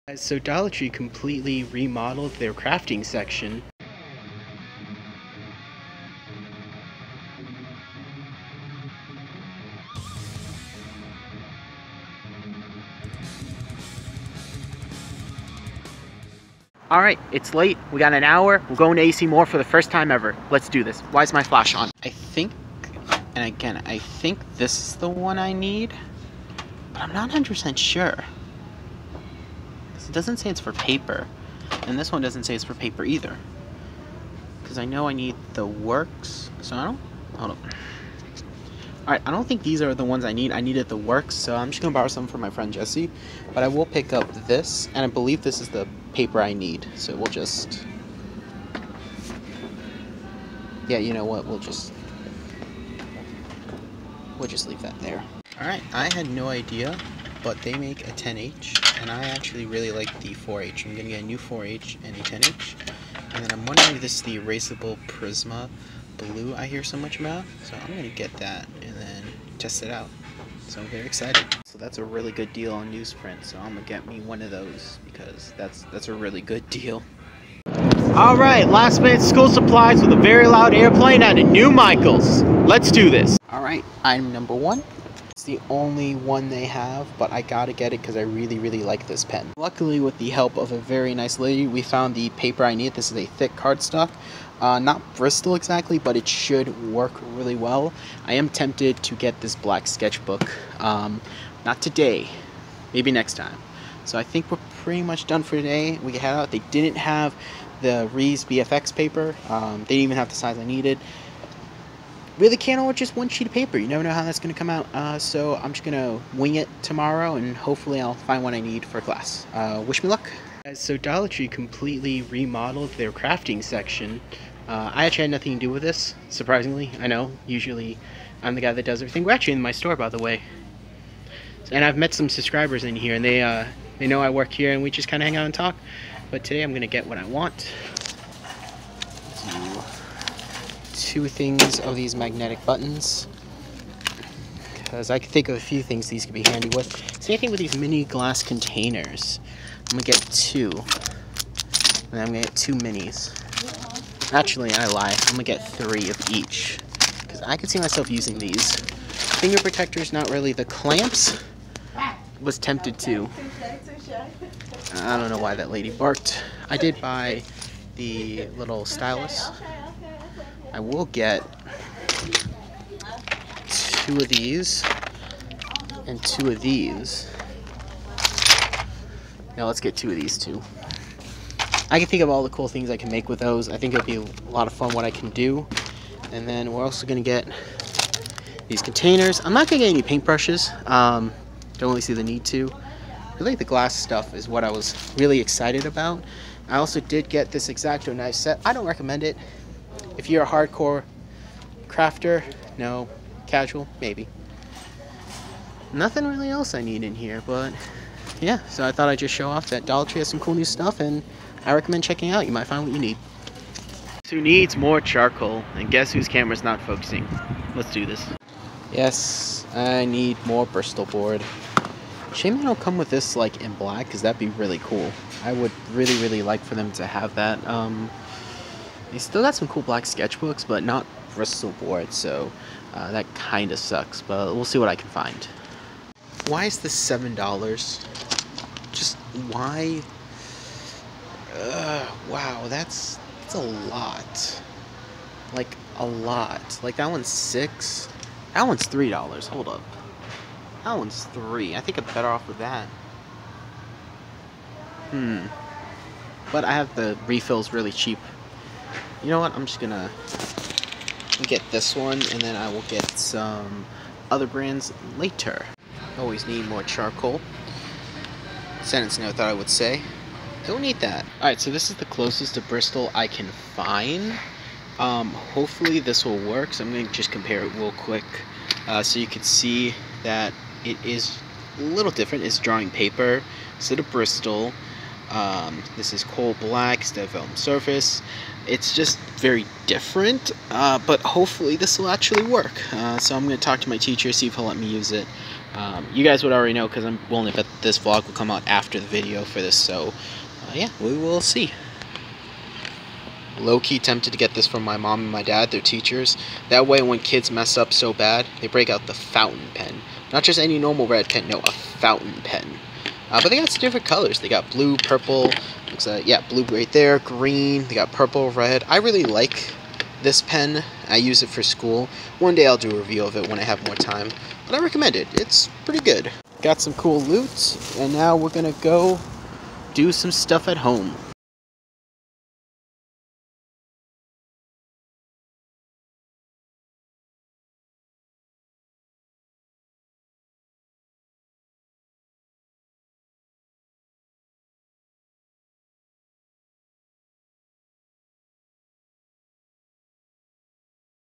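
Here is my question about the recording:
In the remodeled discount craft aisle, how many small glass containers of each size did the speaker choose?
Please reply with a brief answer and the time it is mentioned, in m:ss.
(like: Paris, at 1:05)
3, at 2:35.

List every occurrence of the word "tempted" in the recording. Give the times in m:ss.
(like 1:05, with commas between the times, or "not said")
1:38, 2:42, 5:03.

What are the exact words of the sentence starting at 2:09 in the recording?
We're actually in my store, by the way.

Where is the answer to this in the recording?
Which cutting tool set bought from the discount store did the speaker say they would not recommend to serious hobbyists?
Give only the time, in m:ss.
3:17.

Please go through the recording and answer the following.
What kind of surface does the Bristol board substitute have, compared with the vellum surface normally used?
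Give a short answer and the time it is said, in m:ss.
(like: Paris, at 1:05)
Coal black, at 4:46.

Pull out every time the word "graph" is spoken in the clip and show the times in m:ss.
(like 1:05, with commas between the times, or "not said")
not said.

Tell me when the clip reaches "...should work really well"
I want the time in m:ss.
1:36.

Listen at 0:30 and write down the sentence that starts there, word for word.
It doesn't say it's for paper.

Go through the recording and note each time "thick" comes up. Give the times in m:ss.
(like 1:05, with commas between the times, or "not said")
1:33.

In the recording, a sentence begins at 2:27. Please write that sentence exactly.
Same thing with these mini glass containers.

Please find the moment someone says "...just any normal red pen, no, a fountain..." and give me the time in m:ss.
5:10.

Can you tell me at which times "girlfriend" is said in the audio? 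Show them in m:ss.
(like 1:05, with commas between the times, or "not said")
not said.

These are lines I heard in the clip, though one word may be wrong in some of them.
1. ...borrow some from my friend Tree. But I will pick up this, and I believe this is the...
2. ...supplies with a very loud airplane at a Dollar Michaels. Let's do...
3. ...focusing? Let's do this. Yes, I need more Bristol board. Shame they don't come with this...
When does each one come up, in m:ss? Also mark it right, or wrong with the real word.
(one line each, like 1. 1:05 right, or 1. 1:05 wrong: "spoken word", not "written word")
1. 0:41 wrong: "Jesse", not "Tree"
2. 1:19 wrong: "New", not "Dollar"
3. 3:36 right.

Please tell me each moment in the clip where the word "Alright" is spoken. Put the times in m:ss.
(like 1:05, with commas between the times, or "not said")
0:39, 0:55, 1:17, 1:23, 4:31.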